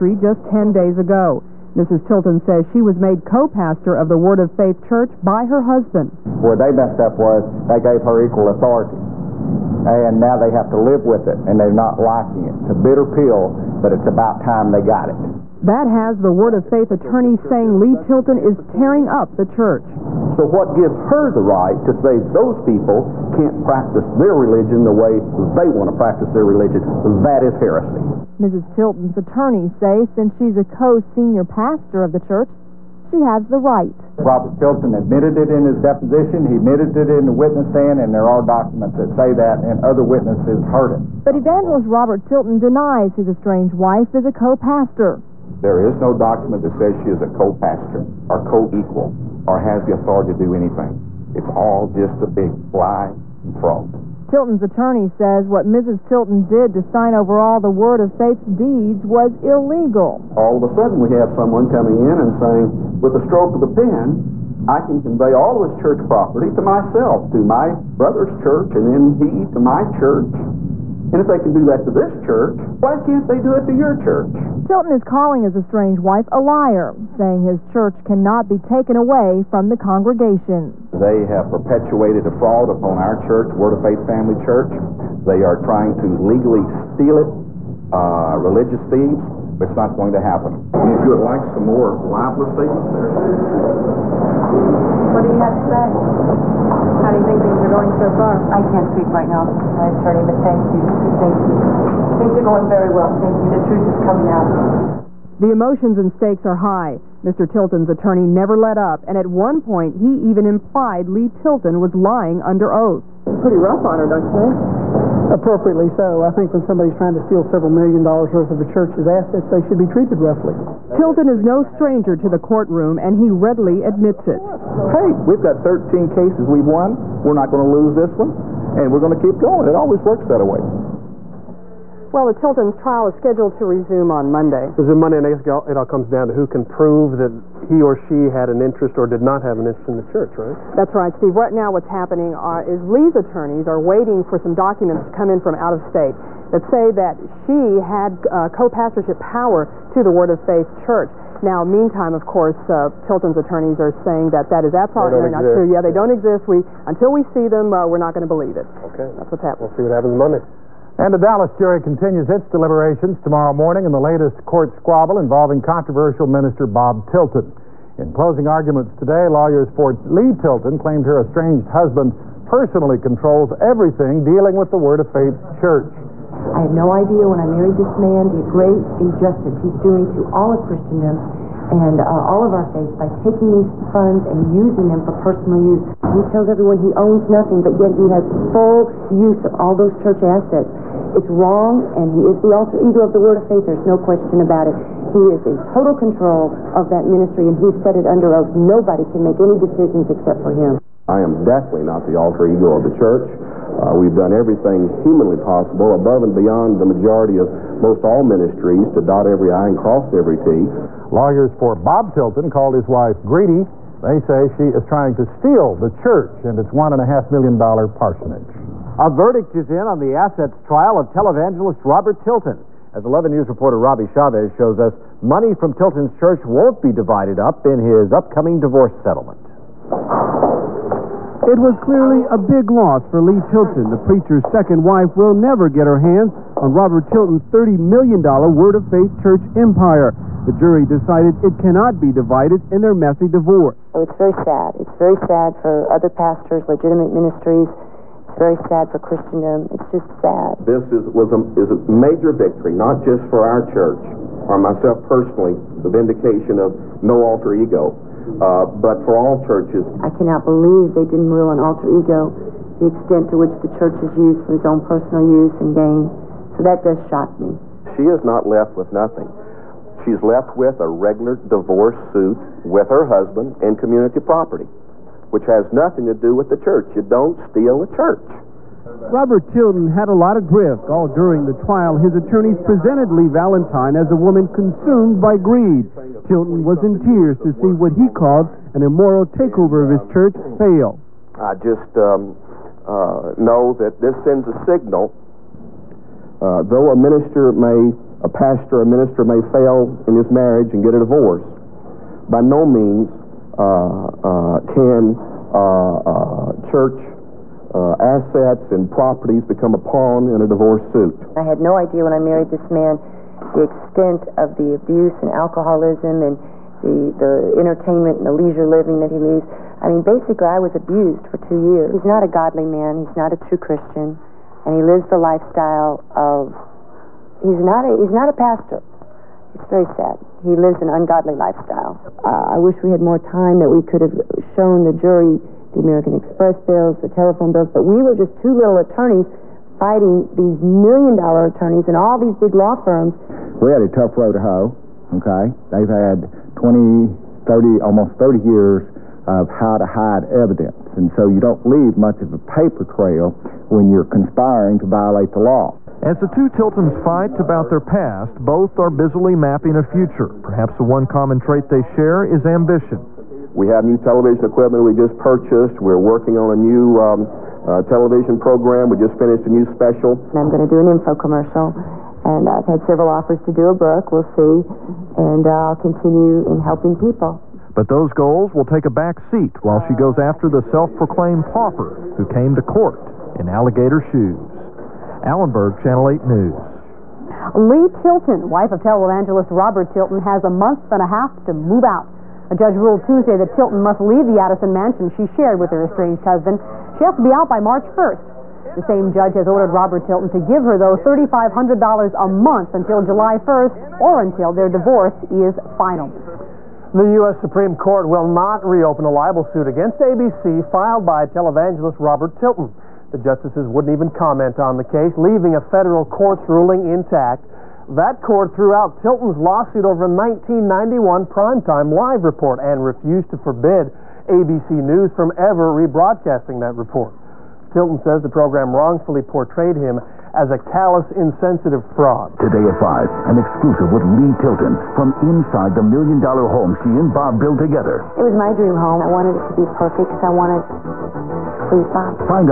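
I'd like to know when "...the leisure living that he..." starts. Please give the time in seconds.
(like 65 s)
318 s.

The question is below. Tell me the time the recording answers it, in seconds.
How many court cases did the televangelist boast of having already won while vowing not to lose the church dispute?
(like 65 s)
125 s.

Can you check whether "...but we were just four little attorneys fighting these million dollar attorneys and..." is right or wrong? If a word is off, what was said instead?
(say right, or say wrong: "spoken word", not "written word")
wrong: "two", not "four".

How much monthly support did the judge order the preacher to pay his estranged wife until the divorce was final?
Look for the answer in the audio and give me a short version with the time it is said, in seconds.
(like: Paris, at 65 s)
$3,500, at 400 s.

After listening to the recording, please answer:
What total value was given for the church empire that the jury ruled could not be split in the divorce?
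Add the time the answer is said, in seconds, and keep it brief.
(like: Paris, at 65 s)
$30 million, at 237 s.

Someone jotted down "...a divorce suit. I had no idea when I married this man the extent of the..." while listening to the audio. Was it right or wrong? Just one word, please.
right.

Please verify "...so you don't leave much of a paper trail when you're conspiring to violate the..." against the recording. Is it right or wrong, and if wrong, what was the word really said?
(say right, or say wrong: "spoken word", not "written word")
right.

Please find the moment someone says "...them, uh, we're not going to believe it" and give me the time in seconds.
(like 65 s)
157 s.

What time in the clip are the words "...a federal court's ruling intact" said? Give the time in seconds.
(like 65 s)
415 s.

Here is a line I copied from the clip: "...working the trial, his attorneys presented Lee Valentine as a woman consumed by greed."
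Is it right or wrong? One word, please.
wrong.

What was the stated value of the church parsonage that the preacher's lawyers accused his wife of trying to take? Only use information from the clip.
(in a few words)
$1.5 million.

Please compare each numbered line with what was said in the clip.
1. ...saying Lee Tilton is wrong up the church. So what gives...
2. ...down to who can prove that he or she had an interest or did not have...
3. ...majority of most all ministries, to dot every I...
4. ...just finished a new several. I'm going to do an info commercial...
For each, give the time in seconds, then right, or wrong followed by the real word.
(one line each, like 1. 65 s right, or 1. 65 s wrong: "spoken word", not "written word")
1. 17 s wrong: "tearing", not "wrong"
2. 136 s right
3. 206 s right
4. 368 s wrong: "special", not "several".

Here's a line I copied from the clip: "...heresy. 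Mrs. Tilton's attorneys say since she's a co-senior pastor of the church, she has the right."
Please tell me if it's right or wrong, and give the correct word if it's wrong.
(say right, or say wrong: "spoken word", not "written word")
right.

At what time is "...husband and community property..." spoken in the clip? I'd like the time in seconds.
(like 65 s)
273 s.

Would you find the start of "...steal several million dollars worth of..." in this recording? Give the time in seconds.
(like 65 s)
117 s.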